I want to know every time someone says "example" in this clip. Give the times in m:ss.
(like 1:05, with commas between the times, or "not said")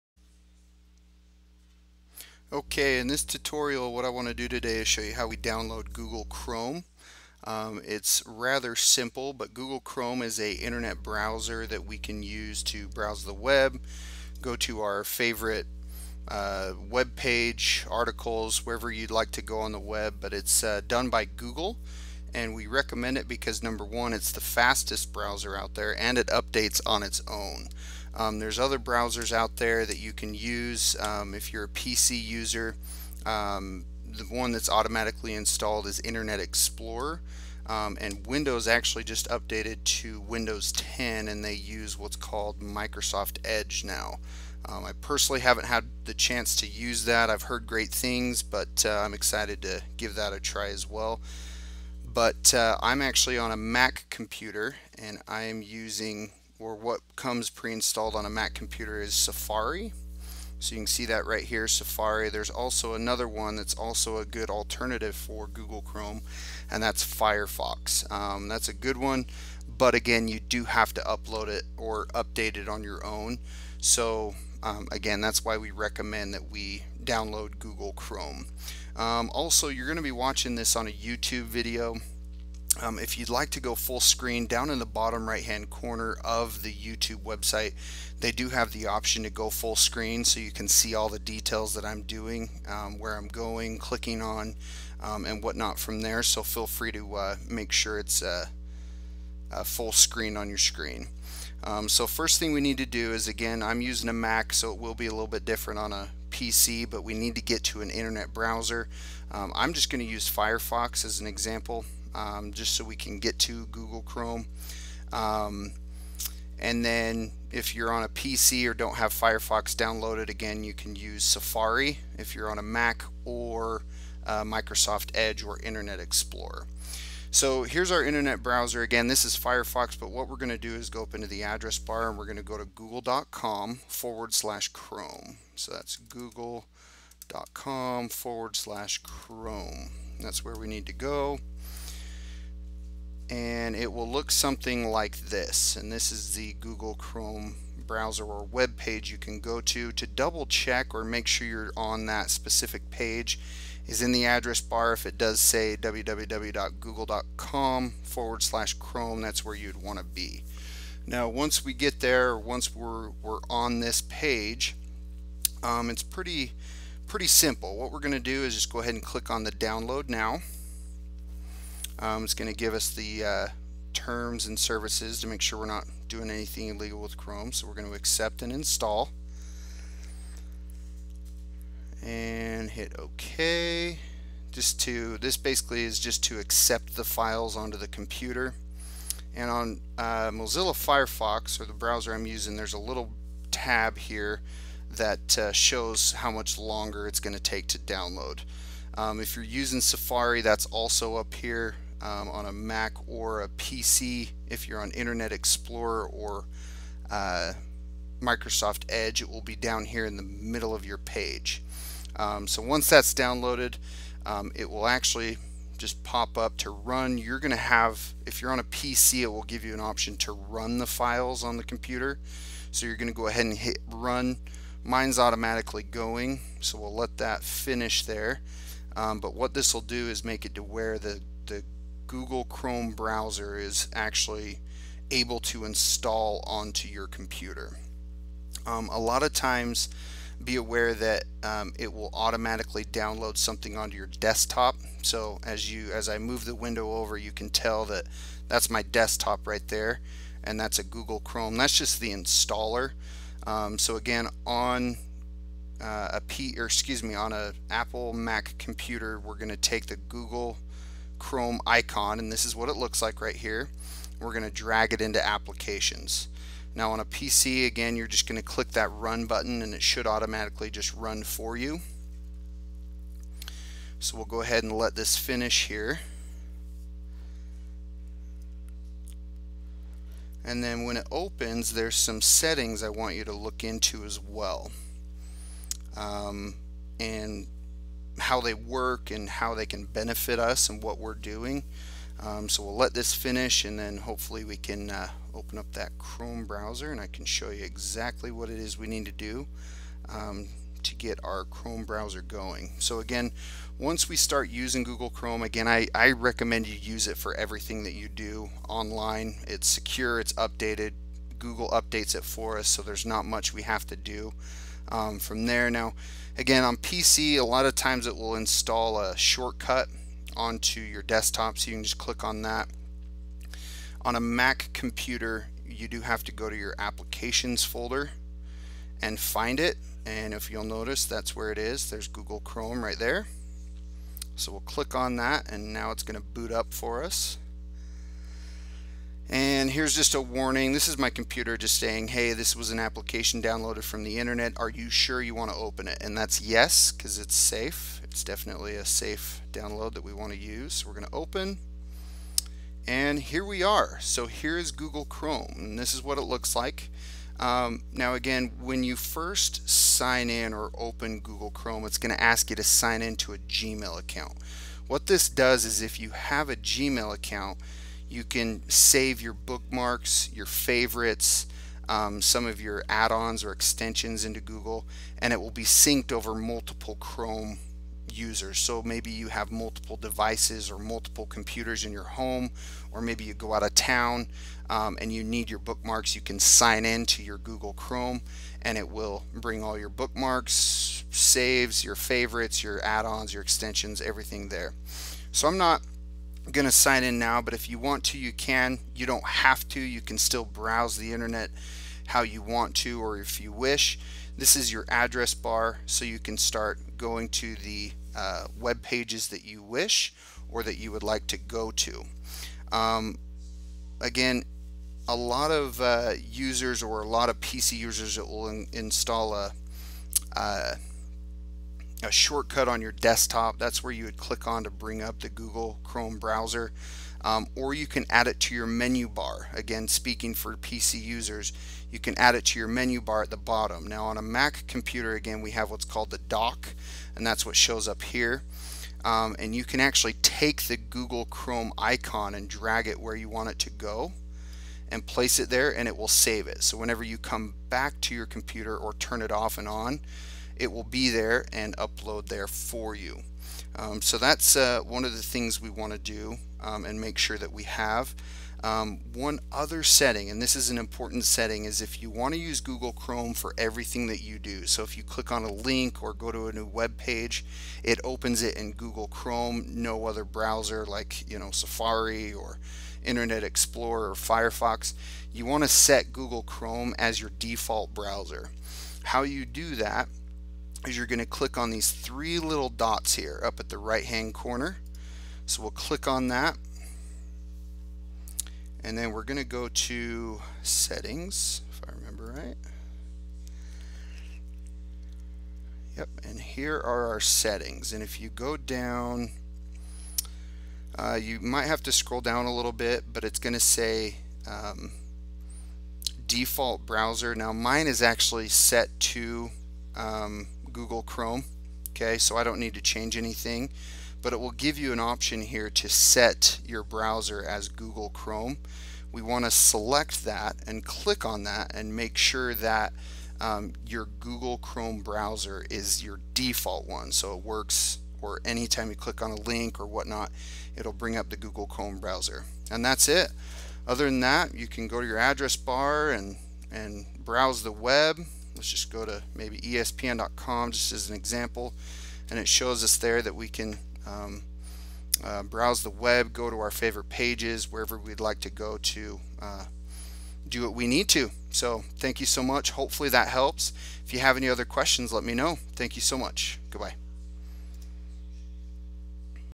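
1:51, 9:01.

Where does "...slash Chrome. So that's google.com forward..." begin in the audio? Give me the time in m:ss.
2:14.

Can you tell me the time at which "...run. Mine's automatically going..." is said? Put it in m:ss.
3:43.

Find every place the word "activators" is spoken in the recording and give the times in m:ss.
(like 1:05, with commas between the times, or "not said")
not said.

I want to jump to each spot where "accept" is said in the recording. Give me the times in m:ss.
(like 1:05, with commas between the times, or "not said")
2:57, 3:06.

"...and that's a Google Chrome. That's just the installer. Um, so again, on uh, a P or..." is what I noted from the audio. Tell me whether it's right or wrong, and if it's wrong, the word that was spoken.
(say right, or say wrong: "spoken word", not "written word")
right.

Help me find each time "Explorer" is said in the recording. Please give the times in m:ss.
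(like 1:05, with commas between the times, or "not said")
0:36, 2:05, 3:25, 7:53.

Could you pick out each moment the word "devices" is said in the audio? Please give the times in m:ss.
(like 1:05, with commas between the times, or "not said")
6:19.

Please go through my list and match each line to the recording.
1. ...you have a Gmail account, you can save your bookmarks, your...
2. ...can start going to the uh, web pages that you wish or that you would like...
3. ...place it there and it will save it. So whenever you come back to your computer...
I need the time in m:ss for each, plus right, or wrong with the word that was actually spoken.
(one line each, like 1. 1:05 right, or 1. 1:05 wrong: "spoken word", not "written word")
1. 6:06 right
2. 6:46 right
3. 7:25 right.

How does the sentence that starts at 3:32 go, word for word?
Um, so once that's downloaded, um, it will actually just pop up to run.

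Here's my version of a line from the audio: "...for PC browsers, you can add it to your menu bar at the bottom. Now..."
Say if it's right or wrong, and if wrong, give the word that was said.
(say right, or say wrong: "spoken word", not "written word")
wrong: "users", not "browsers".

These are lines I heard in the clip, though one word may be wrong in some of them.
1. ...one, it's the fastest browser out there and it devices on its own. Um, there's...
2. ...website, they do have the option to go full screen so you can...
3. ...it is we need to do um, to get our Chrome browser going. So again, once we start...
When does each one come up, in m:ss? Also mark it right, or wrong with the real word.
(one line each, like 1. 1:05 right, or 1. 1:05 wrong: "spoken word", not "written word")
1. 0:23 wrong: "updates", not "devices"
2. 1:27 right
3. 4:58 right.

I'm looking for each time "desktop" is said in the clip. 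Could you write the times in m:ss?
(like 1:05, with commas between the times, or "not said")
4:04, 4:08, 5:21, 7:02.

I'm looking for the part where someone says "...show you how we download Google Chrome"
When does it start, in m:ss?
0:04.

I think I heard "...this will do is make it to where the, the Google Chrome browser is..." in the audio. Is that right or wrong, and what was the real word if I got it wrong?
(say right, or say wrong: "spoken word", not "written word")
right.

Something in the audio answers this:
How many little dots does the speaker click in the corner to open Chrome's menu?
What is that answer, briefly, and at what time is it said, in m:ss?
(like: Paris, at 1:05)
3, at 8:01.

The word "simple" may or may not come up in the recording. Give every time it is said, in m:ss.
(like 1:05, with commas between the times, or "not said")
0:08, 2:47.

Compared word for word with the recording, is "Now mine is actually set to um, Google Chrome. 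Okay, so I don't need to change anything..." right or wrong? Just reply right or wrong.
right.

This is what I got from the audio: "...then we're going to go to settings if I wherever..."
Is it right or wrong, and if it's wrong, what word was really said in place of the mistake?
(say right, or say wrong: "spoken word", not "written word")
wrong: "remember", not "wherever".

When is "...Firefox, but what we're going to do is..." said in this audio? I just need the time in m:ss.
2:09.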